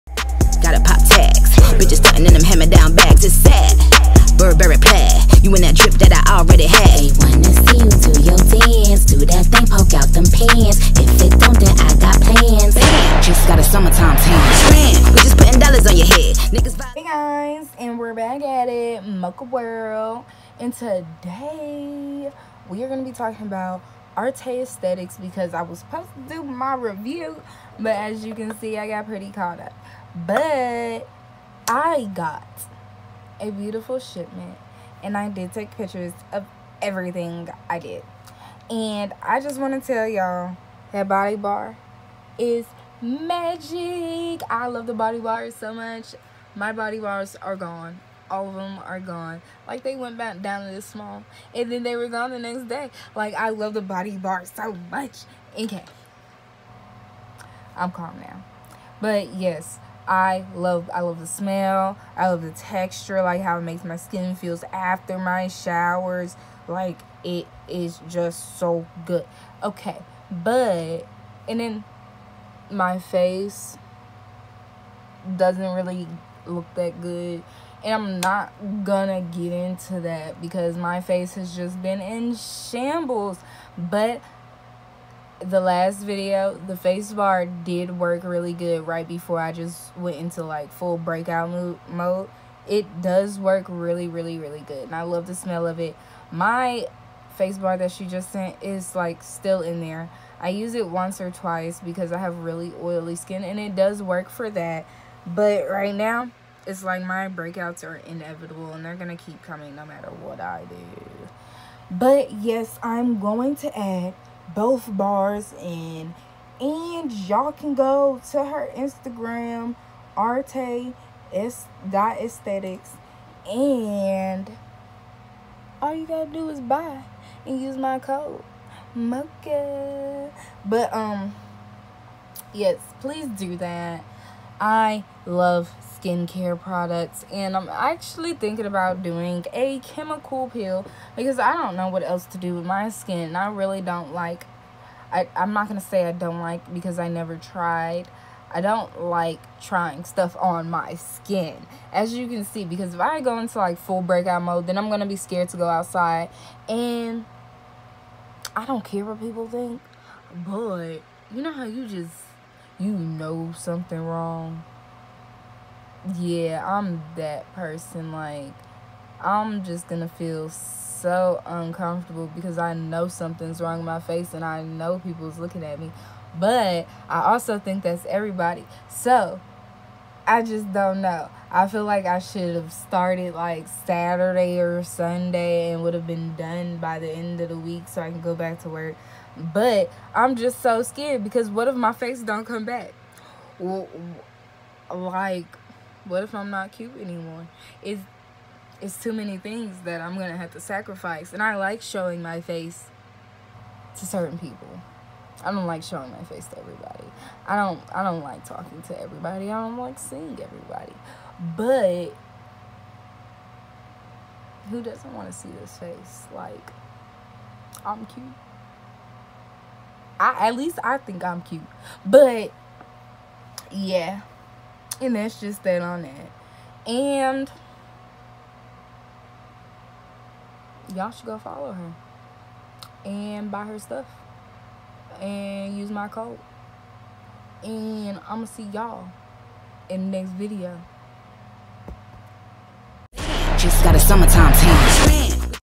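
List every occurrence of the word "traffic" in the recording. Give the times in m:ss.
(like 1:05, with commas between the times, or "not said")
not said.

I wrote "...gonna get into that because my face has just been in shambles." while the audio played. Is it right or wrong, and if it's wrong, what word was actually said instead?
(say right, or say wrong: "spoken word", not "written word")
right.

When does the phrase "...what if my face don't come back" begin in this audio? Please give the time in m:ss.
3:11.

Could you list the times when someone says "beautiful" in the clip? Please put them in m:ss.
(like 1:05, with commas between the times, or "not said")
0:33.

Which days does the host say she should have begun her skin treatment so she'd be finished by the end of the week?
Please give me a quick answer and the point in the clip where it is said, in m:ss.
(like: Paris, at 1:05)
Saturday or Sunday, at 3:03.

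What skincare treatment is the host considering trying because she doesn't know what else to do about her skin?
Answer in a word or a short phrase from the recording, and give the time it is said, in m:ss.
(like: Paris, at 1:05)
Chemical peel, at 2:19.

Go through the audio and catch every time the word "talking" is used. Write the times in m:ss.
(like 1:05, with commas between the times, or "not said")
0:23, 3:28.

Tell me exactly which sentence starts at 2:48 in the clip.
Like, I'm just gonna feel so uncomfortable because I know something's wrong with my face and I know people's looking at me.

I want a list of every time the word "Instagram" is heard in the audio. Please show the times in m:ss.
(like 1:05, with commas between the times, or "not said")
1:58.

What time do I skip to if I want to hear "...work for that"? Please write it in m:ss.
1:44.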